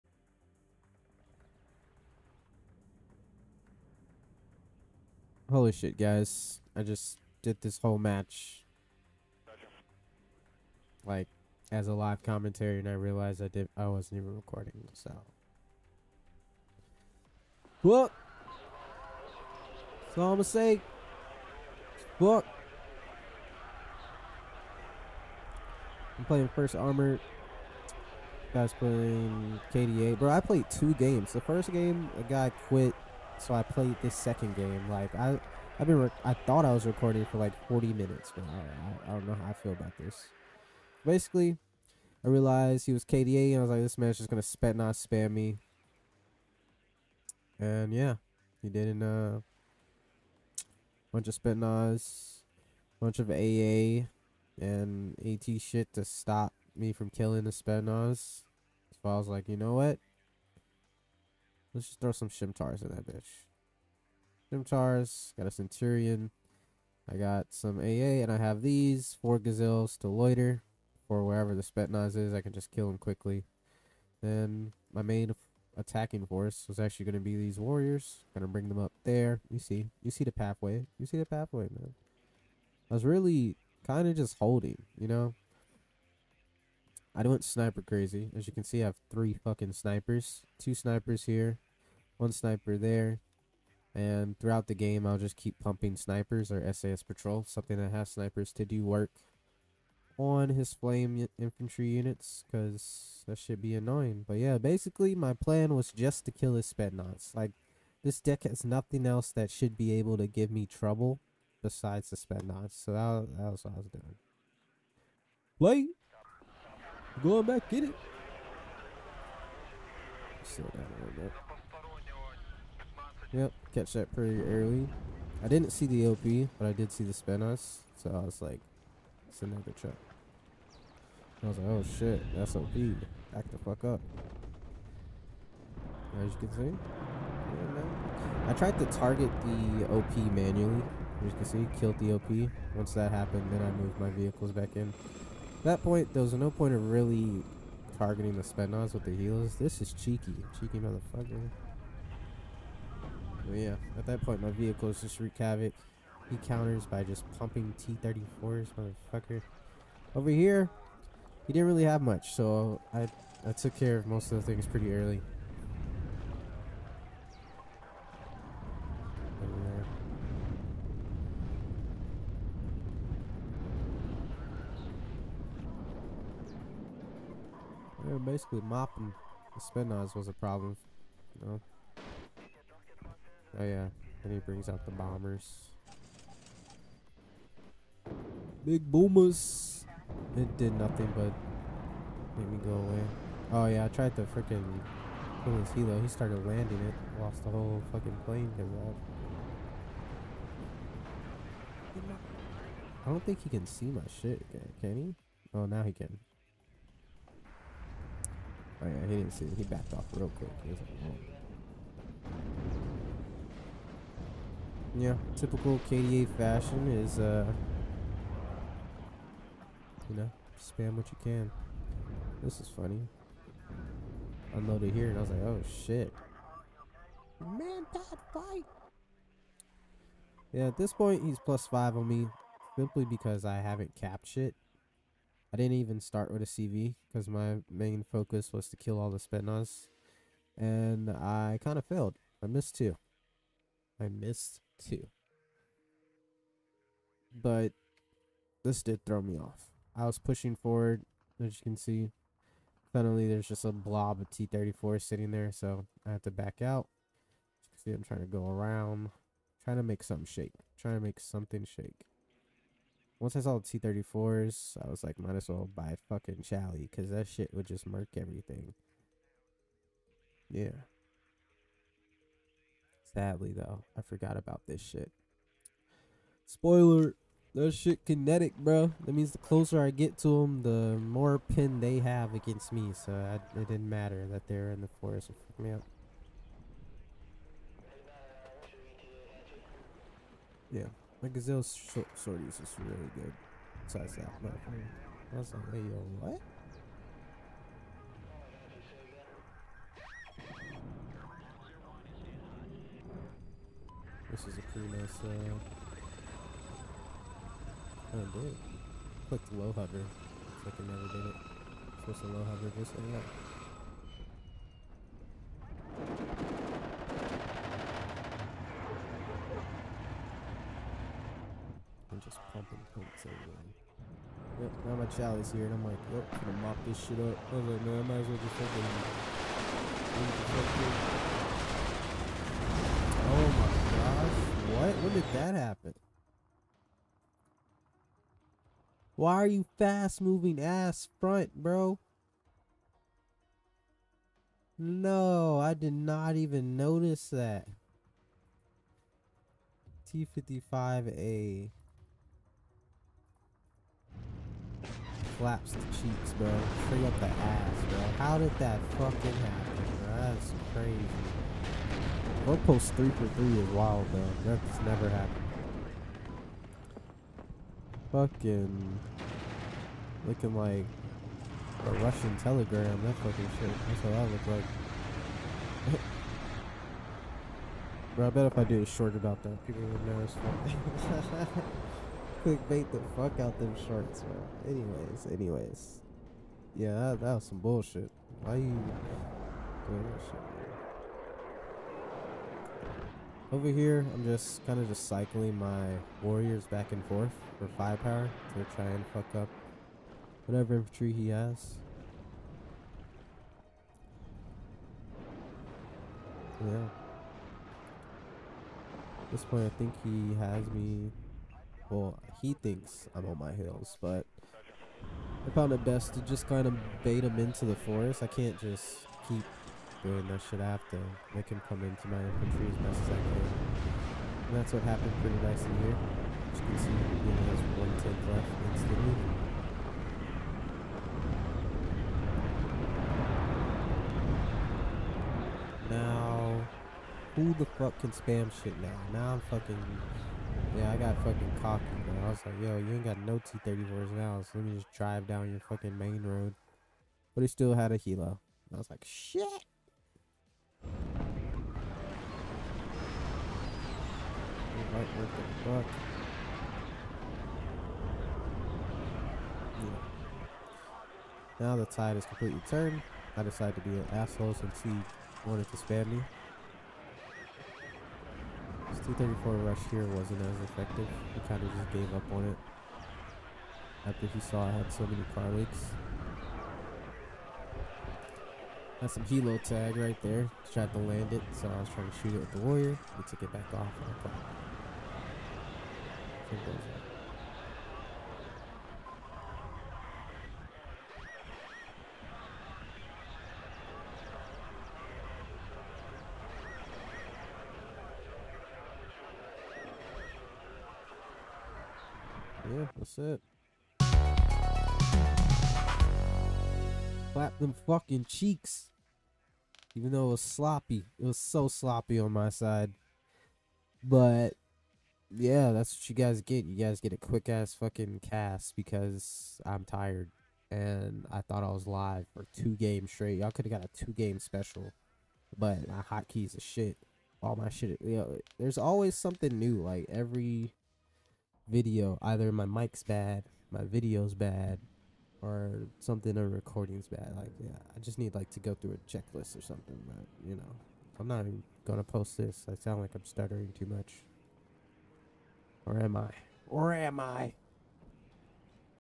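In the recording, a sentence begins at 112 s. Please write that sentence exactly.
So that, that was what I was doing.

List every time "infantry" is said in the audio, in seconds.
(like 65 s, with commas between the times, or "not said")
101 s, 400 s, 422 s.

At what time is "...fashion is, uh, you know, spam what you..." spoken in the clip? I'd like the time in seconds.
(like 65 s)
216 s.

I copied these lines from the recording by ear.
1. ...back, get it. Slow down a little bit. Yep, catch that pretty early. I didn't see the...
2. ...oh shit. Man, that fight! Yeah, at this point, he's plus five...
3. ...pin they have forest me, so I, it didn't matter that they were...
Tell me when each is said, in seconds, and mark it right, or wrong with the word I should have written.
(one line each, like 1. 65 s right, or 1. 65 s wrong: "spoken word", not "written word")
1. 117 s right
2. 225 s right
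3. 281 s wrong: "against", not "forest".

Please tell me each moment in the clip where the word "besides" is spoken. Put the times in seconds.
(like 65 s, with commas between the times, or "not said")
111 s, 293 s.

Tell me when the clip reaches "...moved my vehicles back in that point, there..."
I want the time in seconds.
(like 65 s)
143 s.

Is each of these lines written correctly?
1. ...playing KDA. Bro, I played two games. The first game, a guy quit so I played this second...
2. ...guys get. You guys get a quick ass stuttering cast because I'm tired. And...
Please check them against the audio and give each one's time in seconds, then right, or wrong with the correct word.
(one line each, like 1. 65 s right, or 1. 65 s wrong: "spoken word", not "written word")
1. 28 s right
2. 516 s wrong: "fucking", not "stuttering".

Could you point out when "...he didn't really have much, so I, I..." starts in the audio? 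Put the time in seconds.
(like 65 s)
161 s.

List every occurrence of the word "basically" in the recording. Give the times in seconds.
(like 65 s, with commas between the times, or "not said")
41 s, 104 s, 178 s.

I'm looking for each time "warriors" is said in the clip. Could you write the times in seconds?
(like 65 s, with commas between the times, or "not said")
77 s, 396 s, 482 s.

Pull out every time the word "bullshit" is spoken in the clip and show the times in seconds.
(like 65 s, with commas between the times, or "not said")
387 s.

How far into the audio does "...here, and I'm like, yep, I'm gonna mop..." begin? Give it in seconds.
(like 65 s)
325 s.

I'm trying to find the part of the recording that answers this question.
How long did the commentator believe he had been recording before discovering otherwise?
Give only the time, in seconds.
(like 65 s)
37 s.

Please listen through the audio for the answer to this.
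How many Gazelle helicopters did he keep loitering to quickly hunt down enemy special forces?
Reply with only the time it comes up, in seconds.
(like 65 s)
69 s.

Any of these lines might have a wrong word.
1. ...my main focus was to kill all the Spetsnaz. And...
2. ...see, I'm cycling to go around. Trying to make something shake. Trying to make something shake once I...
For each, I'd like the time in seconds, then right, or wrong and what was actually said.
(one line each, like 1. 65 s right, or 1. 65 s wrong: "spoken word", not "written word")
1. 237 s right
2. 257 s wrong: "trying", not "cycling".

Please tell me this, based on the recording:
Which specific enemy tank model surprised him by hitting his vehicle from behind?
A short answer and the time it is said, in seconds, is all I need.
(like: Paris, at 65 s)
T55A, at 350 s.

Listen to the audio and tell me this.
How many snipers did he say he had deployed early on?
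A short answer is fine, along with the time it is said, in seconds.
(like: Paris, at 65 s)
3, at 89 s.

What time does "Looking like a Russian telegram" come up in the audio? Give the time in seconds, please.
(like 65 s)
370 s.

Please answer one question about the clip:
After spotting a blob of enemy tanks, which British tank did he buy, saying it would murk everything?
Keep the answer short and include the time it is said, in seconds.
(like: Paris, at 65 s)
Chally, at 266 s.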